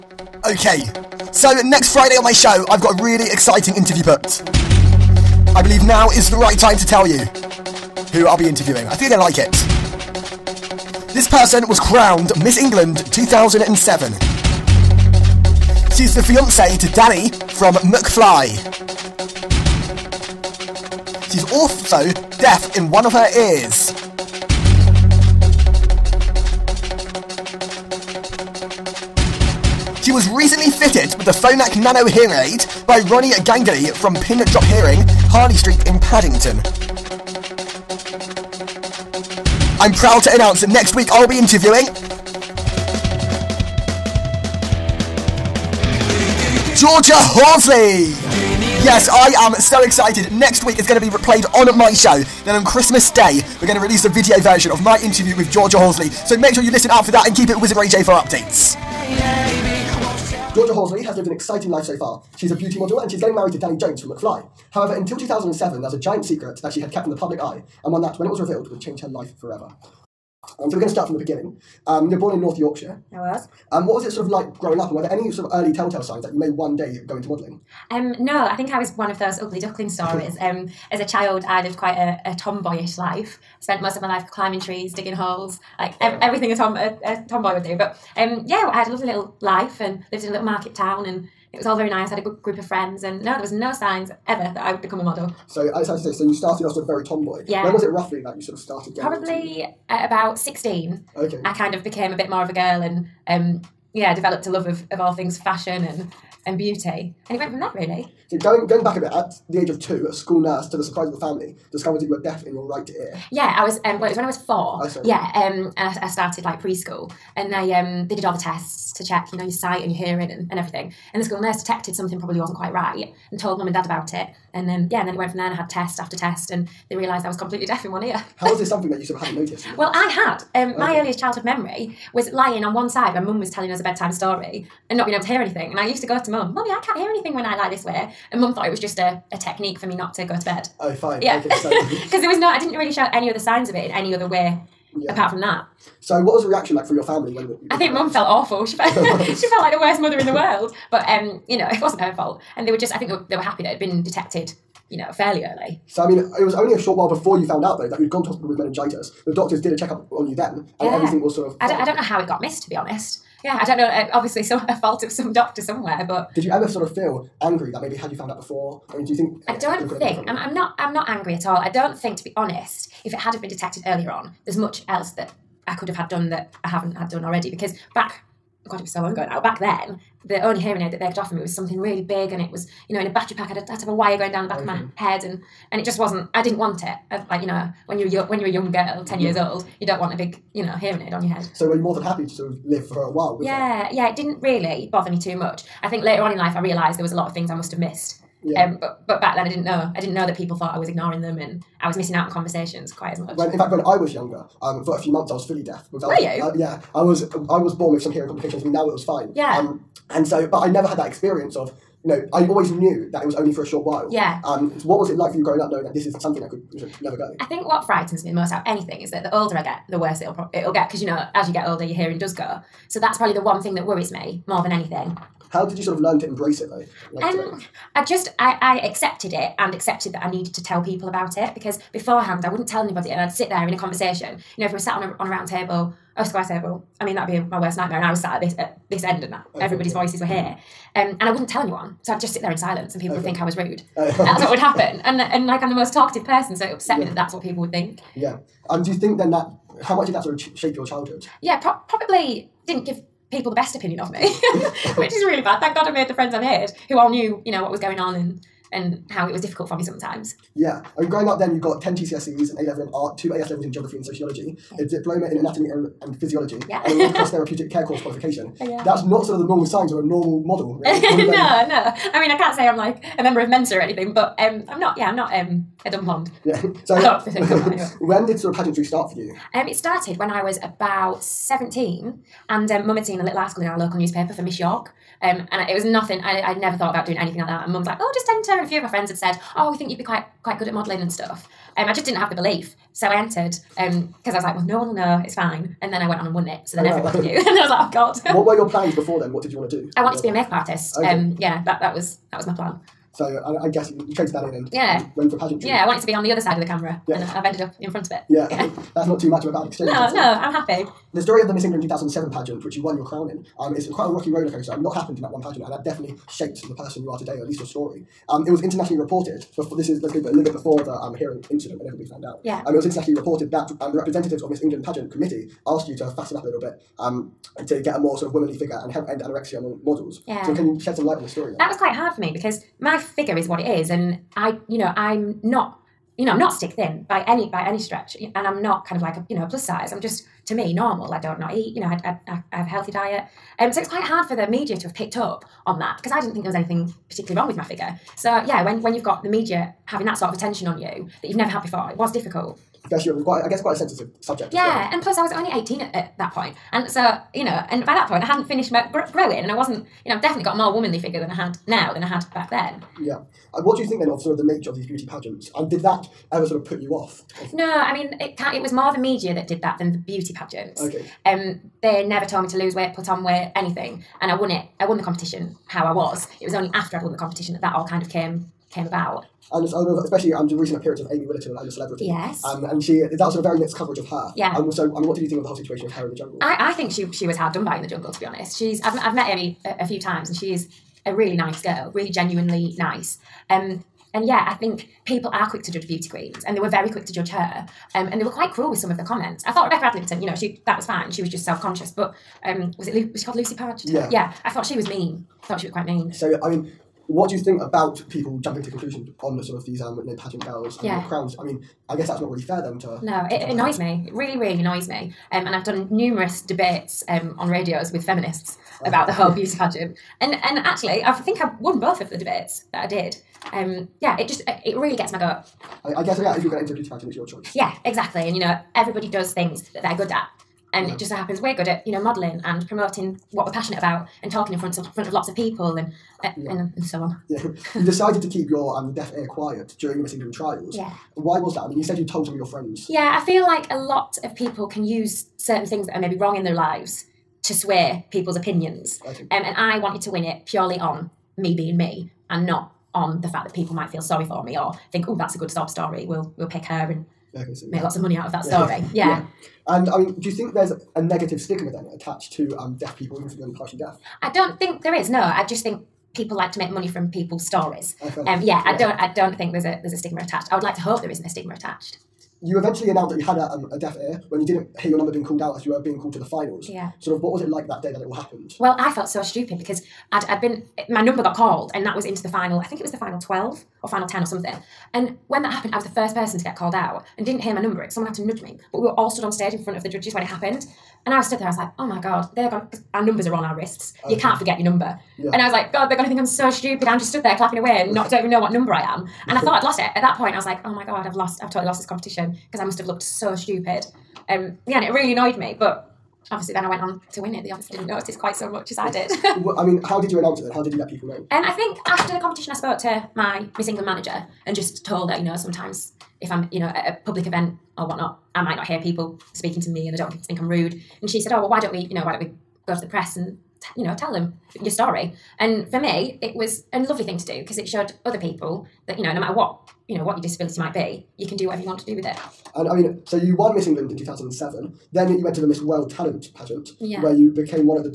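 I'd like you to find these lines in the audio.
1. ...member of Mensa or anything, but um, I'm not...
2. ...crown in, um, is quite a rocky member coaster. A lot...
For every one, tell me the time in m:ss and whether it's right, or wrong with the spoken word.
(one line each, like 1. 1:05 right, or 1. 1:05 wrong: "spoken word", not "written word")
1. 4:33 right
2. 5:13 wrong: "roller", not "member".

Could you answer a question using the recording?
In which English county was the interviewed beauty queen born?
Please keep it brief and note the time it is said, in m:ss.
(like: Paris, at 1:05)
North Yorkshire, at 1:12.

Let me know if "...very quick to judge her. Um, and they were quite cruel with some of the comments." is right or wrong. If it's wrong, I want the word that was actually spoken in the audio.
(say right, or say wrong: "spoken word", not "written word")
right.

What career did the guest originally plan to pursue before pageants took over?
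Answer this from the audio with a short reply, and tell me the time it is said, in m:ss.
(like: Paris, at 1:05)
Makeup artist, at 5:00.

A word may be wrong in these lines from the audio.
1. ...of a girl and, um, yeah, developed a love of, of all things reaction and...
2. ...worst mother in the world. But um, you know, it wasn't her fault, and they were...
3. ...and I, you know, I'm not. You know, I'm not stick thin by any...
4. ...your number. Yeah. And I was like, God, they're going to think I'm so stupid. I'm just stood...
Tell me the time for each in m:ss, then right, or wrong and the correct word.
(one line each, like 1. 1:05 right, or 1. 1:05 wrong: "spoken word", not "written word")
1. 1:42 wrong: "fashion", not "reaction"
2. 2:29 right
3. 5:33 right
4. 8:14 right.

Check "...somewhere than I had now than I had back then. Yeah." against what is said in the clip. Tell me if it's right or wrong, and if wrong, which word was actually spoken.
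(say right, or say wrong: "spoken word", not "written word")
wrong: "figure", not "somewhere".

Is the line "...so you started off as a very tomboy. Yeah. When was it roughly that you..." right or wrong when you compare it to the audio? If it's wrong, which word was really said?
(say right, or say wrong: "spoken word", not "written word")
right.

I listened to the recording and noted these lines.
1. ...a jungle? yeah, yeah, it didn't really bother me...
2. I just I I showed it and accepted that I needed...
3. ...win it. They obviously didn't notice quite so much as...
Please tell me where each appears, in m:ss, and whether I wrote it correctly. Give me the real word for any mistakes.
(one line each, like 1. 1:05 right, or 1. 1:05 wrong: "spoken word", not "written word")
1. 3:13 wrong: "while", not "jungle"
2. 3:47 wrong: "accepted", not "showed"
3. 8:27 right.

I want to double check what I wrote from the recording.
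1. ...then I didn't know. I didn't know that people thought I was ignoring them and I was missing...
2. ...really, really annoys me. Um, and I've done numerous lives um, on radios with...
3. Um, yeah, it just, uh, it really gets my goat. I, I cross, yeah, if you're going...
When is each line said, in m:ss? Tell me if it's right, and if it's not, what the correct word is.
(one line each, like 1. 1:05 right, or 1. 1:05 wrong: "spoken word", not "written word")
1. 3:19 right
2. 6:54 wrong: "debates", not "lives"
3. 7:03 wrong: "guess", not "cross".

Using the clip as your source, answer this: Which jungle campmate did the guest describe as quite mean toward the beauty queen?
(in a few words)
Lucy Podge.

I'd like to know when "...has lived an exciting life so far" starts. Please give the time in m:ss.
1:01.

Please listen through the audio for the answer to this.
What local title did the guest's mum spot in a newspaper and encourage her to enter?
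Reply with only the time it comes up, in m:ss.
4:44.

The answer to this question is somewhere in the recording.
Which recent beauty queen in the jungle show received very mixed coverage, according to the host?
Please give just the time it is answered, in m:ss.
6:21.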